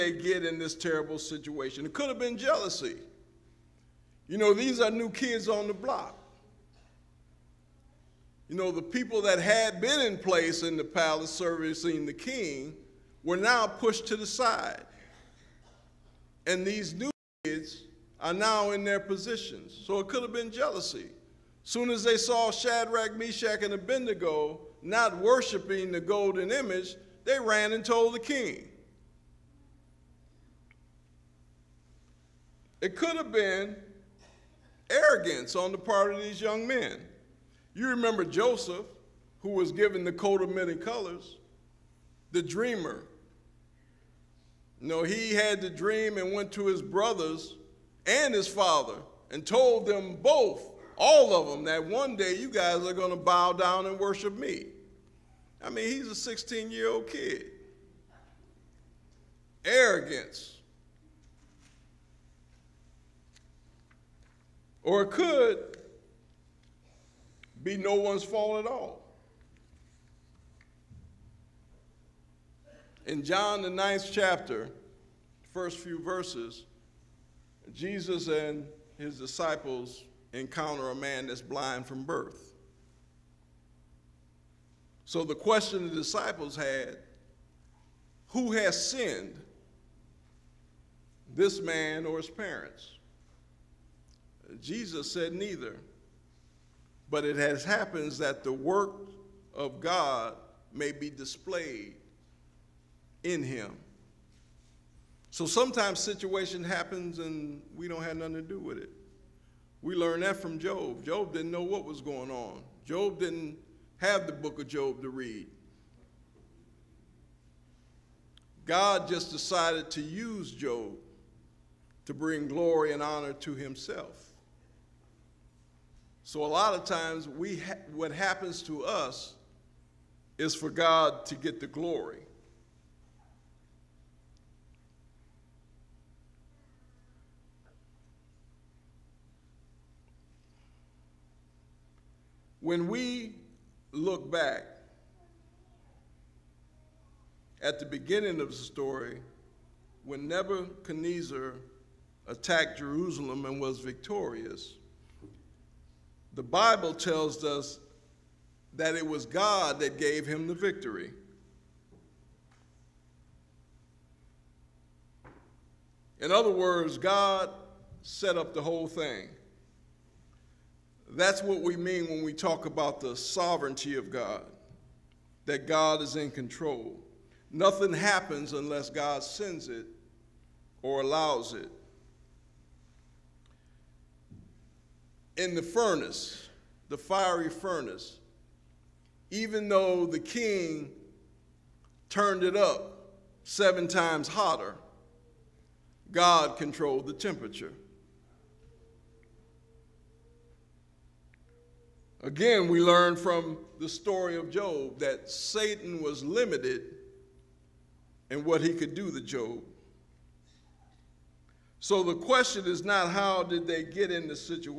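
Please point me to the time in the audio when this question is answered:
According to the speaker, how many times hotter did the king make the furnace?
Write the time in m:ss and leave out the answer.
3:13.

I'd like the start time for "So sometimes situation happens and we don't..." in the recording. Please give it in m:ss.
1:45.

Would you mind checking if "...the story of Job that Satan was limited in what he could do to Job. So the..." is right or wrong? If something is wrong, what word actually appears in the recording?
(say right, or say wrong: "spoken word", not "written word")
right.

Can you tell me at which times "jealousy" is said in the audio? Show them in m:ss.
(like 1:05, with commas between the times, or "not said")
0:02, 0:20.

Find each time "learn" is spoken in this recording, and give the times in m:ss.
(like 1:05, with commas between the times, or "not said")
1:49, 3:22.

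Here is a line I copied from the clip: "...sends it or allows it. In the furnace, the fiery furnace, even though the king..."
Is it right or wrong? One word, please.
right.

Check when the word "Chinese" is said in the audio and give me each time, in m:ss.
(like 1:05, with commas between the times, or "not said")
not said.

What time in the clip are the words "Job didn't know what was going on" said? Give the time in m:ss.
1:51.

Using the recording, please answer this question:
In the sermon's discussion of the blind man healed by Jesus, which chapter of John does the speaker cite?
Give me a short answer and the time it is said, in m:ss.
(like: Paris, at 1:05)
9th chapter, at 1:13.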